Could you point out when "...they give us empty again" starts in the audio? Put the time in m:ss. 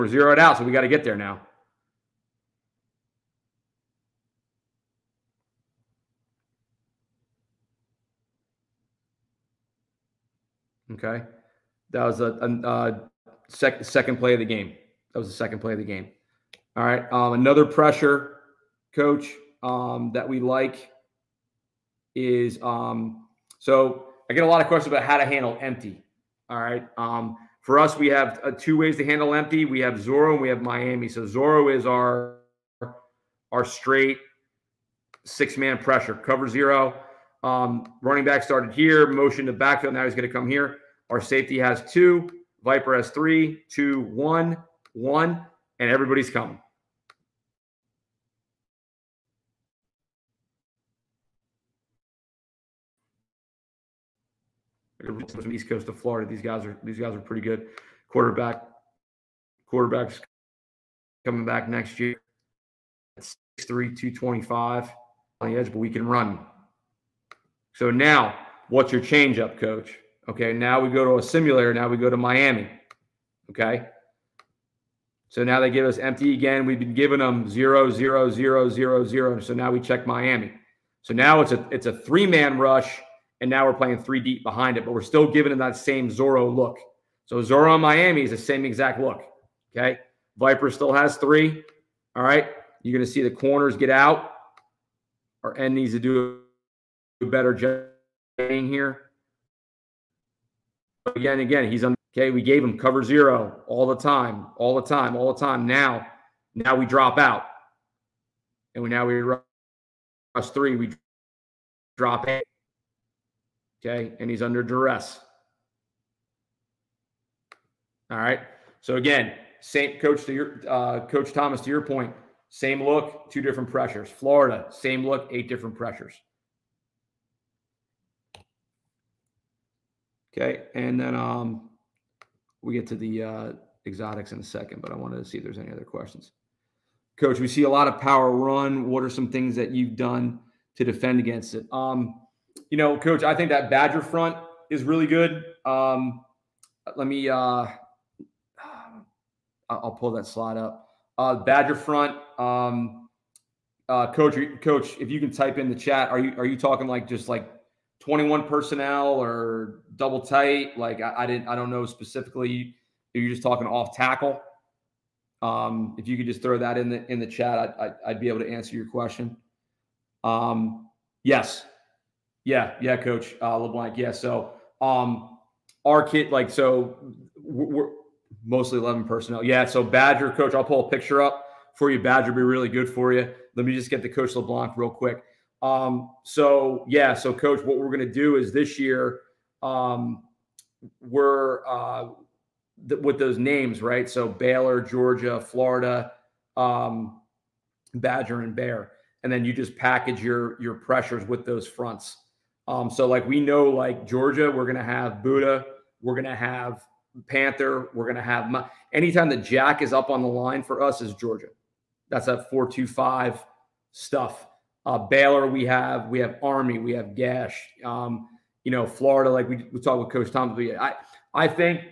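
1:15.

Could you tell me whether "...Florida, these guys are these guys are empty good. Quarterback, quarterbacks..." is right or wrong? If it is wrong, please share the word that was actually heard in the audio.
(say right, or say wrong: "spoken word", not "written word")
wrong: "pretty", not "empty".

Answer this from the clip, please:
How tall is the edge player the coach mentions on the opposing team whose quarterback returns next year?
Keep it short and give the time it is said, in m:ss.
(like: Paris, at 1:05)
6'3", at 1:03.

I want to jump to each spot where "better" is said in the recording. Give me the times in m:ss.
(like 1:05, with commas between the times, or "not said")
1:37.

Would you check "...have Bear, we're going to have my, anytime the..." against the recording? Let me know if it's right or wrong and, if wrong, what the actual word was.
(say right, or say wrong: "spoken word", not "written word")
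wrong: "Panther", not "Bear".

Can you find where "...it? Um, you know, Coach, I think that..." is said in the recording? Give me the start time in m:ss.
2:21.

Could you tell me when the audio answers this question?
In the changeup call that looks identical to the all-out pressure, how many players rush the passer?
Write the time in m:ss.
1:21.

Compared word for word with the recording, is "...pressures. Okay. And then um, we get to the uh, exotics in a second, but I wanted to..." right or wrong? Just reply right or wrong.
right.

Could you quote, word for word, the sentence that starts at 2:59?
Yeah, so Badger, Coach, I'll pull a picture up for you.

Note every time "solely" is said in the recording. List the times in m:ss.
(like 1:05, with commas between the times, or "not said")
not said.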